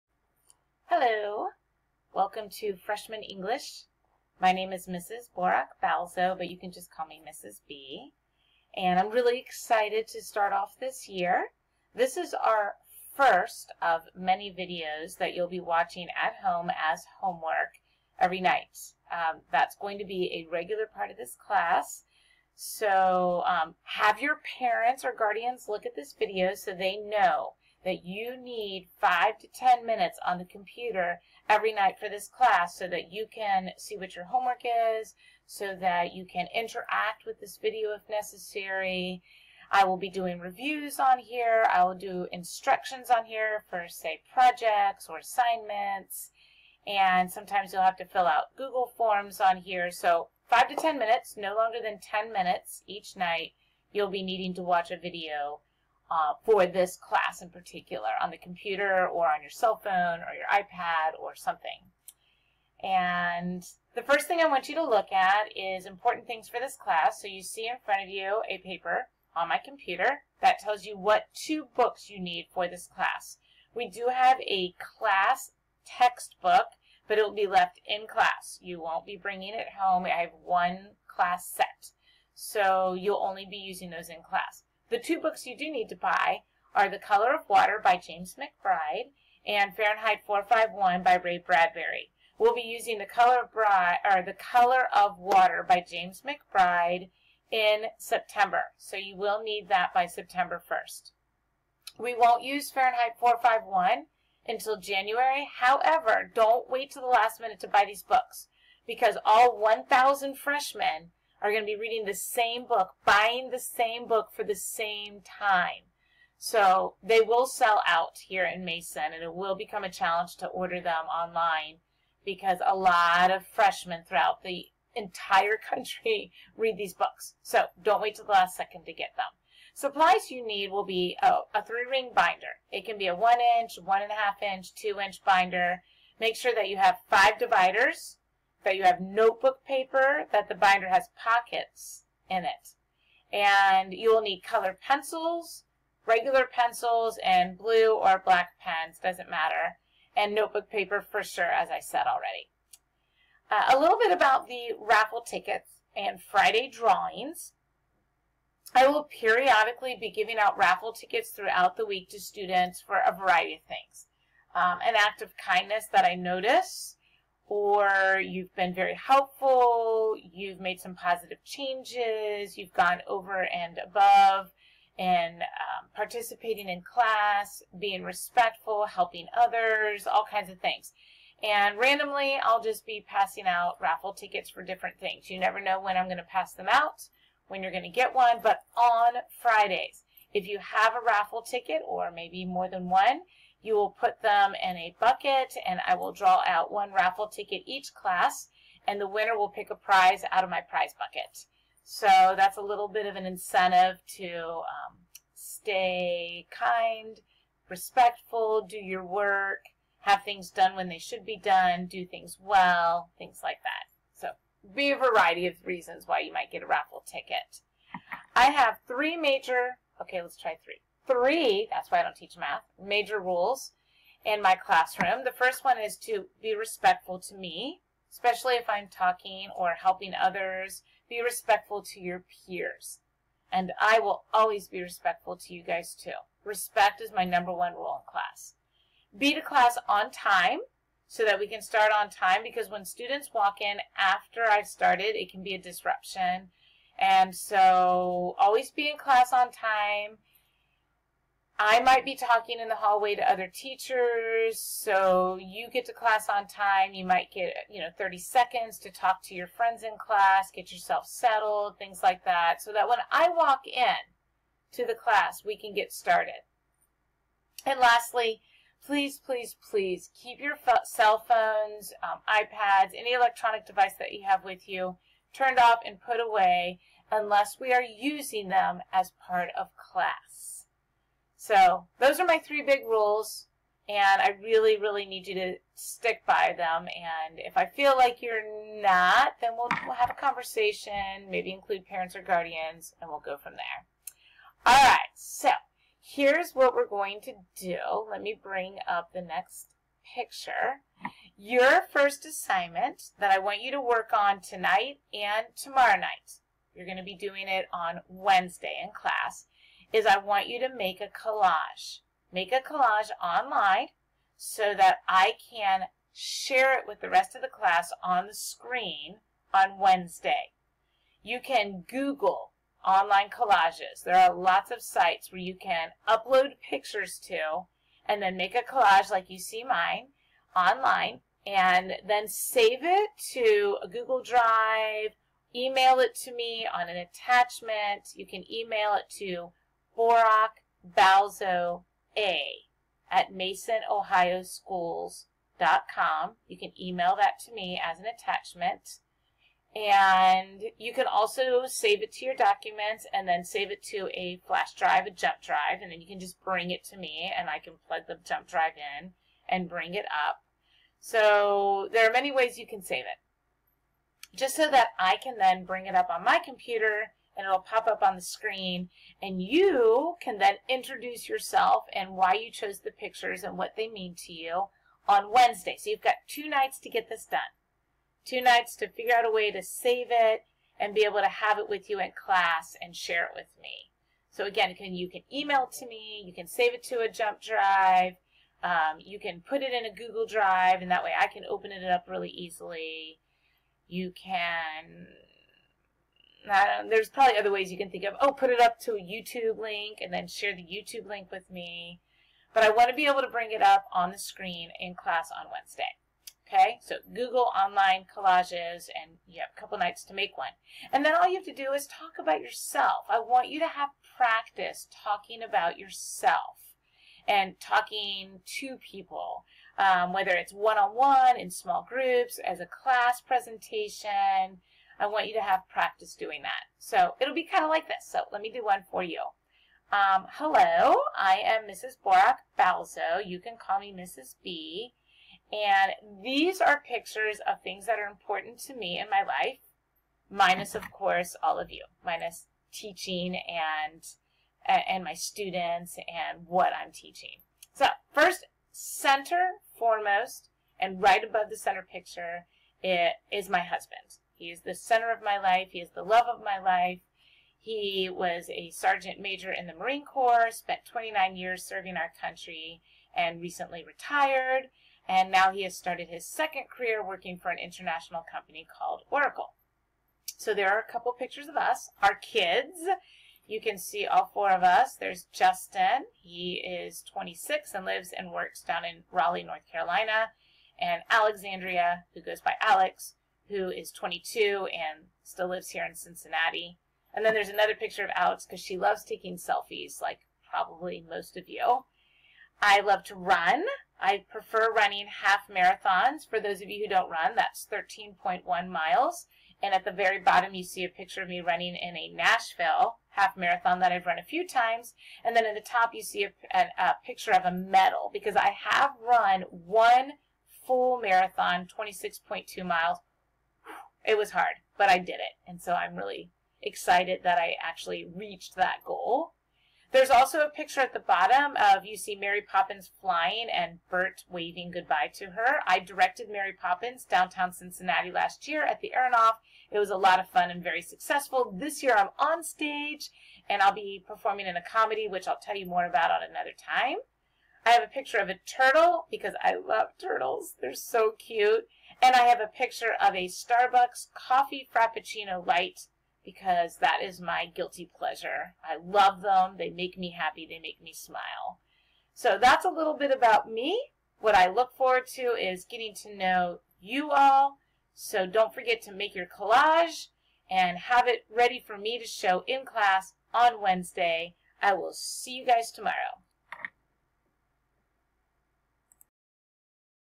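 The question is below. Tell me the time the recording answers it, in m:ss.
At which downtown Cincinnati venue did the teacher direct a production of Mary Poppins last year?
8:48.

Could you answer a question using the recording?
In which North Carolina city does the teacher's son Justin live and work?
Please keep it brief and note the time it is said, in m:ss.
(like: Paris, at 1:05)
Raleigh, at 7:59.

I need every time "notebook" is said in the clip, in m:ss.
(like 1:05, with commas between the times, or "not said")
2:19, 2:30.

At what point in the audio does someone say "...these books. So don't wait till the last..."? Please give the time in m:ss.
2:06.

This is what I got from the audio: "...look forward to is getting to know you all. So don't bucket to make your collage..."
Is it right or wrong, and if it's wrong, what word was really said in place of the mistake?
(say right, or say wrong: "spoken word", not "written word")
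wrong: "forget", not "bucket".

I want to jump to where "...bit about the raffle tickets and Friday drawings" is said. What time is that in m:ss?
2:33.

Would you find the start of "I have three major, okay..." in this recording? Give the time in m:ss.
3:38.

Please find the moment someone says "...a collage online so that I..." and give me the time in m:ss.
5:12.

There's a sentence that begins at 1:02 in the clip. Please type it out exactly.
And the first thing I want you to look at is important things for this class.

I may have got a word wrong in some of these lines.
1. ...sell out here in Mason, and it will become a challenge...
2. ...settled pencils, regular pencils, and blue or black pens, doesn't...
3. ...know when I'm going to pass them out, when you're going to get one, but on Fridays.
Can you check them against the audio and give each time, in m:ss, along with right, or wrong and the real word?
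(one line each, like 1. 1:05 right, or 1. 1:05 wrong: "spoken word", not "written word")
1. 1:57 right
2. 2:24 wrong: "colored", not "settled"
3. 3:05 right.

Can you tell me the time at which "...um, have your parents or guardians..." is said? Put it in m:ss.
0:23.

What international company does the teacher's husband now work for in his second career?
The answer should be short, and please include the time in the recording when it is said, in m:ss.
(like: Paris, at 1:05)
Oracle, at 7:49.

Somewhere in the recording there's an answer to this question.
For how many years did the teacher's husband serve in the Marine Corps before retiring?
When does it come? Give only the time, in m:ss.
7:40.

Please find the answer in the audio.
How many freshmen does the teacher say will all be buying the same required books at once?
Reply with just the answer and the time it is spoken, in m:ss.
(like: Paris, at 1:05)
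1,000, at 1:49.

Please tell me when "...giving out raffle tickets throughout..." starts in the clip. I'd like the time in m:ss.
2:40.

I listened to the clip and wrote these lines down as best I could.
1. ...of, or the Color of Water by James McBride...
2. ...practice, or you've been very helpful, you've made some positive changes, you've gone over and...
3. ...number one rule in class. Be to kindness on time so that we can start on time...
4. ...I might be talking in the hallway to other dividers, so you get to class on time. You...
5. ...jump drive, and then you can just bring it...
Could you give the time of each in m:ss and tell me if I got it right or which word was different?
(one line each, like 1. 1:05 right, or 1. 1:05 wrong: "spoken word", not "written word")
1. 1:33 right
2. 2:46 wrong: "notice", not "practice"
3. 3:57 wrong: "class", not "kindness"
4. 4:11 wrong: "teachers", not "dividers"
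5. 5:55 right.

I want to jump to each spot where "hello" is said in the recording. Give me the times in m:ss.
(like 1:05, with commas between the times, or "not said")
0:01, 7:10.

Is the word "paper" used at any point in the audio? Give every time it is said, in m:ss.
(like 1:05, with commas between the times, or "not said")
1:08, 2:19, 2:30.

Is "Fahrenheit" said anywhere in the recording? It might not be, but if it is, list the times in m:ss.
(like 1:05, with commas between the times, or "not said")
1:29, 1:42.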